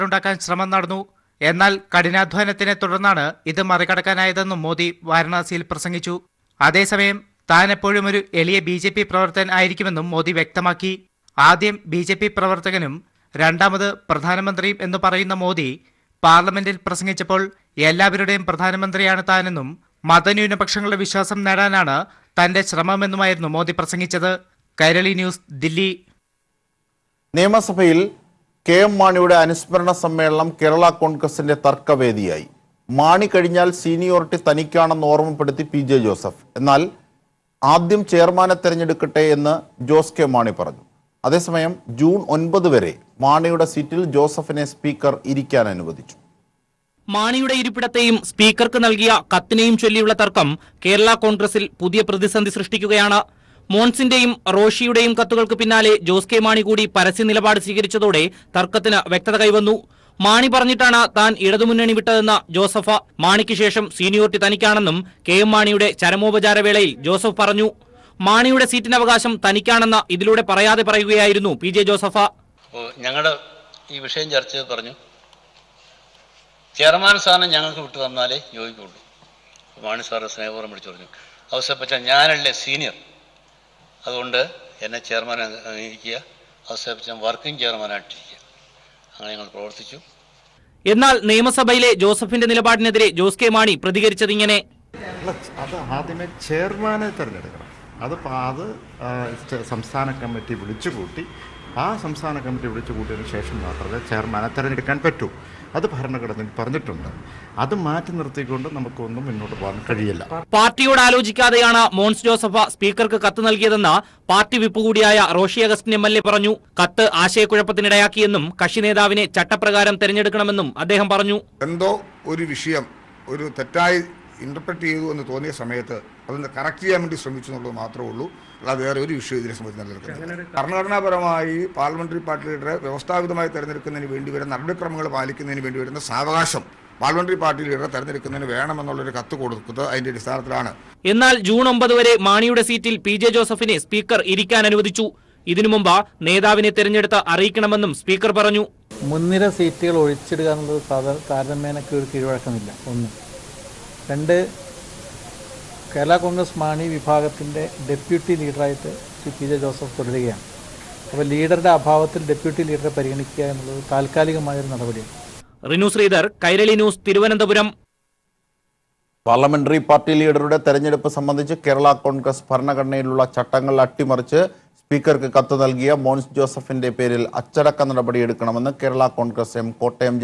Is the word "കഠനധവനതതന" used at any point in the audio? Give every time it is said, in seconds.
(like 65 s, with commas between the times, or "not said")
1 s.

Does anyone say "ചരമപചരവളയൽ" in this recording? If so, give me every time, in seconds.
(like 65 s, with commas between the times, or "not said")
66 s.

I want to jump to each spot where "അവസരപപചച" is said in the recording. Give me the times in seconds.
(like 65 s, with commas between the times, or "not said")
81 s, 86 s.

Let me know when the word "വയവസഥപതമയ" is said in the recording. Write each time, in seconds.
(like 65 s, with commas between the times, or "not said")
132 s.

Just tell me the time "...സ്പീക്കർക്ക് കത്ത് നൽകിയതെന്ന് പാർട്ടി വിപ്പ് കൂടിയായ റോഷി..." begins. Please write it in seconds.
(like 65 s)
112 s.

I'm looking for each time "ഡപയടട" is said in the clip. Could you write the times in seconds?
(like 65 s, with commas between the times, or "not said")
157 s, 162 s.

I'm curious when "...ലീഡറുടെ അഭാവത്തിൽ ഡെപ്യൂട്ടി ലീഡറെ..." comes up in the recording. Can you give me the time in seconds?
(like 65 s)
161 s.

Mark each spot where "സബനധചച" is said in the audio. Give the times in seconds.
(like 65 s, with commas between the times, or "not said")
129 s, 171 s.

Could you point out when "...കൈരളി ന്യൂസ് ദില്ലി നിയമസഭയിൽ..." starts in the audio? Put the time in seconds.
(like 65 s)
24 s.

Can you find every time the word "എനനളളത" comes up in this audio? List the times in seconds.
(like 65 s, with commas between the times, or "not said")
127 s, 163 s.